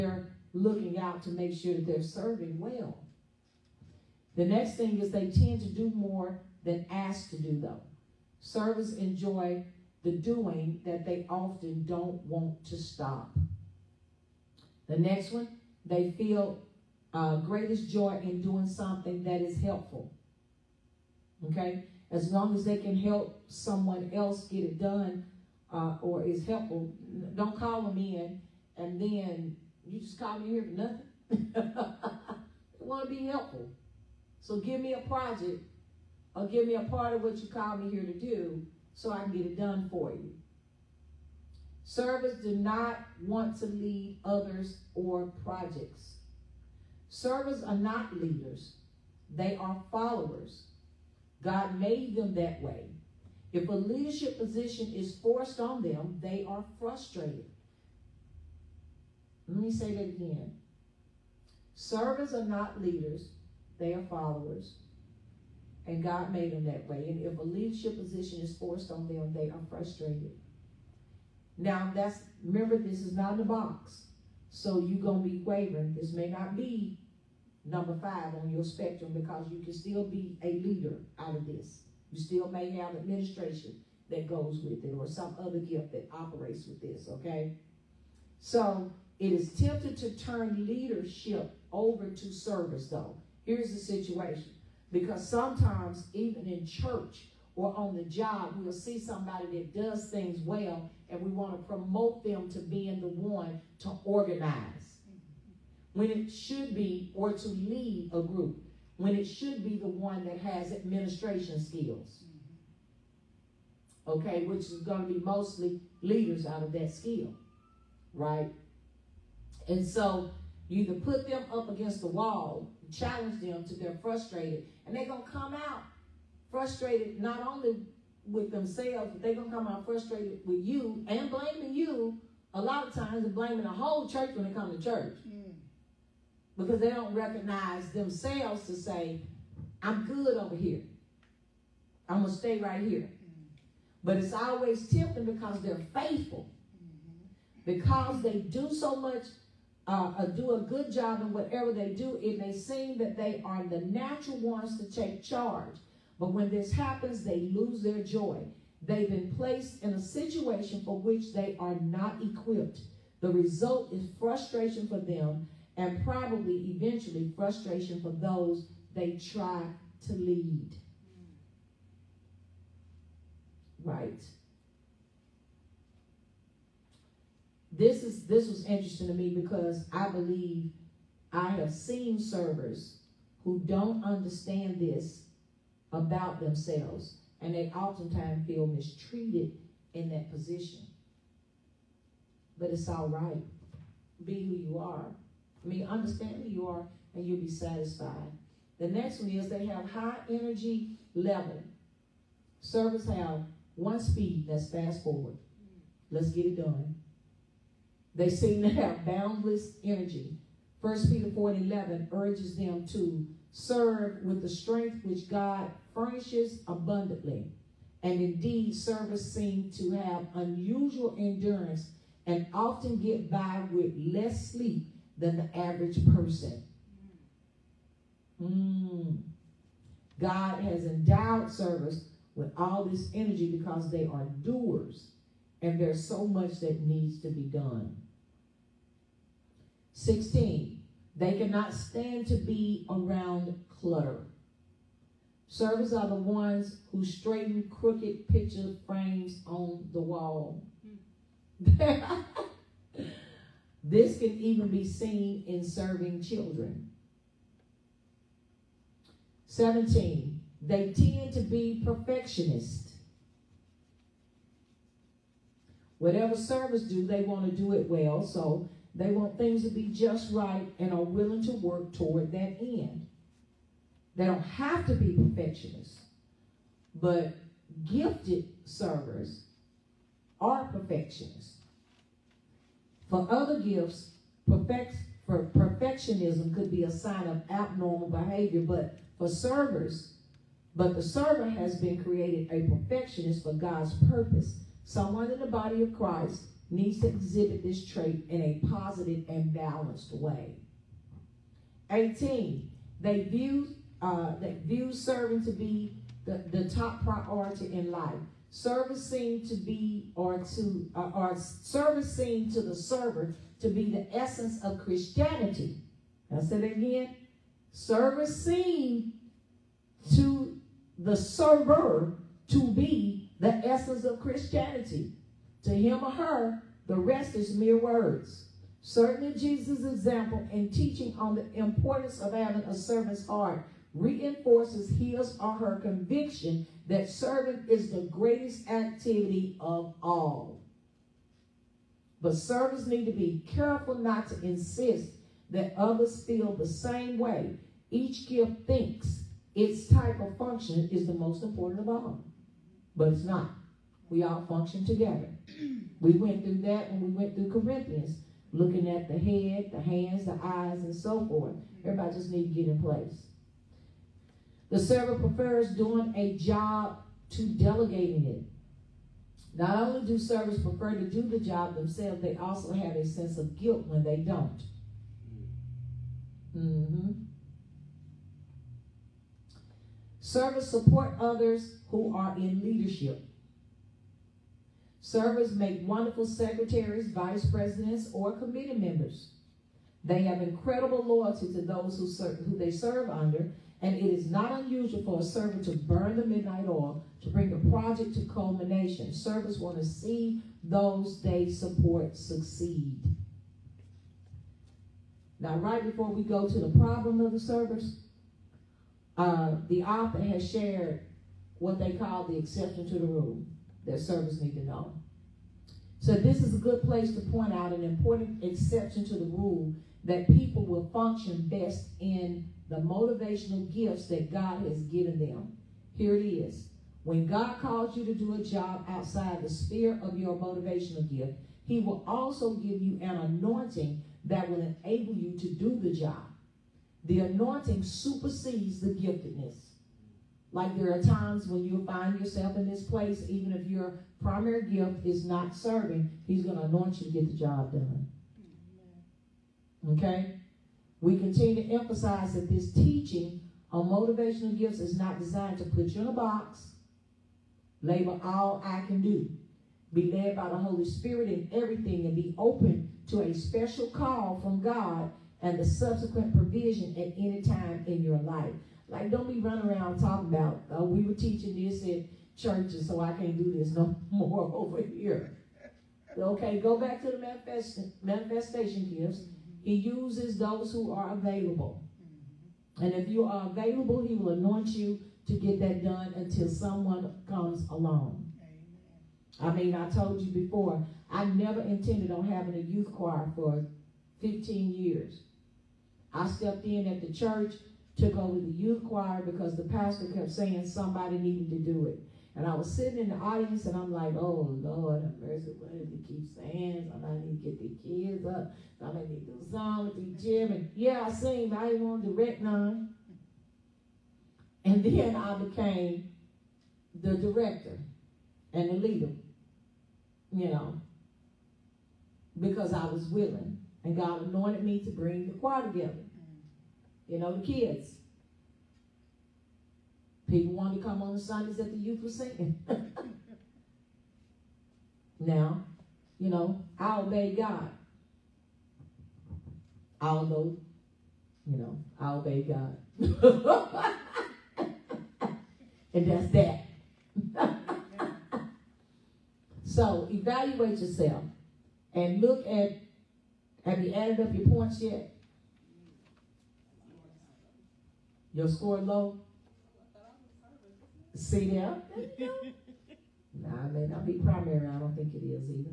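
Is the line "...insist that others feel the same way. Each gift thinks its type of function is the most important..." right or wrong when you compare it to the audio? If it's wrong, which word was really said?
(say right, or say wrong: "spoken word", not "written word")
right.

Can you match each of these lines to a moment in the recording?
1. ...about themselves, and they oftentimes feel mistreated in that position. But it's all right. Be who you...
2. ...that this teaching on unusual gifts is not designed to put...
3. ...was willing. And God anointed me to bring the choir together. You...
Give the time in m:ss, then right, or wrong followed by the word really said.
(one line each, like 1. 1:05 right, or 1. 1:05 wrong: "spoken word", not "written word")
1. 3:05 right
2. 7:32 wrong: "motivational", not "unusual"
3. 8:42 right.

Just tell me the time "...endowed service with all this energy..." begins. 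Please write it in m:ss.
3:50.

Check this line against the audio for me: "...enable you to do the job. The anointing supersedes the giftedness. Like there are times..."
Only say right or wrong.
right.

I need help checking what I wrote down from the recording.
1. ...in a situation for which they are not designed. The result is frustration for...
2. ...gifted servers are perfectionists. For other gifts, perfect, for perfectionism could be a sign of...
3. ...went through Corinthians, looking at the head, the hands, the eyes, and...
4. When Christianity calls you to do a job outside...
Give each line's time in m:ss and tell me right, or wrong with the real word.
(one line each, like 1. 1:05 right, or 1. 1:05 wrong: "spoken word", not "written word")
1. 2:39 wrong: "equipped", not "designed"
2. 4:37 right
3. 5:57 right
4. 7:07 wrong: "God", not "Christianity".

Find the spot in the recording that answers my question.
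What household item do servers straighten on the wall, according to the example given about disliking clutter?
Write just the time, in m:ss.
4:08.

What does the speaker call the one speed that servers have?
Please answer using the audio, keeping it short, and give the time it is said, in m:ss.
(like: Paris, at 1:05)
Fast forward, at 3:24.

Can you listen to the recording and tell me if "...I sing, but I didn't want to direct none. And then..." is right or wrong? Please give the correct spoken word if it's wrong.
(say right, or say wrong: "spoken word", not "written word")
right.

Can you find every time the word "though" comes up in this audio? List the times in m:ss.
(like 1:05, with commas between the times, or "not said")
0:07, 1:32.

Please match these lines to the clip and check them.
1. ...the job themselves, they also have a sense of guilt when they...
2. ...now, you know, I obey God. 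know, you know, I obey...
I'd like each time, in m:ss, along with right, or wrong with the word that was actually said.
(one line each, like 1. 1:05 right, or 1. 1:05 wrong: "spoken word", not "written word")
1. 6:11 right
2. 8:55 right.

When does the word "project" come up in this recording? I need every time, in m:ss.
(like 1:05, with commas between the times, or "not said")
0:35, 0:45, 6:37.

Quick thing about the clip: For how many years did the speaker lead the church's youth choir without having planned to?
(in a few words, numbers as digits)
15.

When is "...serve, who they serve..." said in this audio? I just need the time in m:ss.
6:32.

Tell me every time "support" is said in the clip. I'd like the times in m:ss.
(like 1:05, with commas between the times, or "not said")
6:20, 6:41.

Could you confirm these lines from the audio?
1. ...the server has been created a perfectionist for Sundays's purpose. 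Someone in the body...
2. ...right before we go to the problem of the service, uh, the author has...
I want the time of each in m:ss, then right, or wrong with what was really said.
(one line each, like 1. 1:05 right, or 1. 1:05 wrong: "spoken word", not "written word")
1. 4:50 wrong: "God", not "Sundays"
2. 6:45 right.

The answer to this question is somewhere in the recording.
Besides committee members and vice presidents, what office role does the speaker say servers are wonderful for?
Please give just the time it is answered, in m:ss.
6:26.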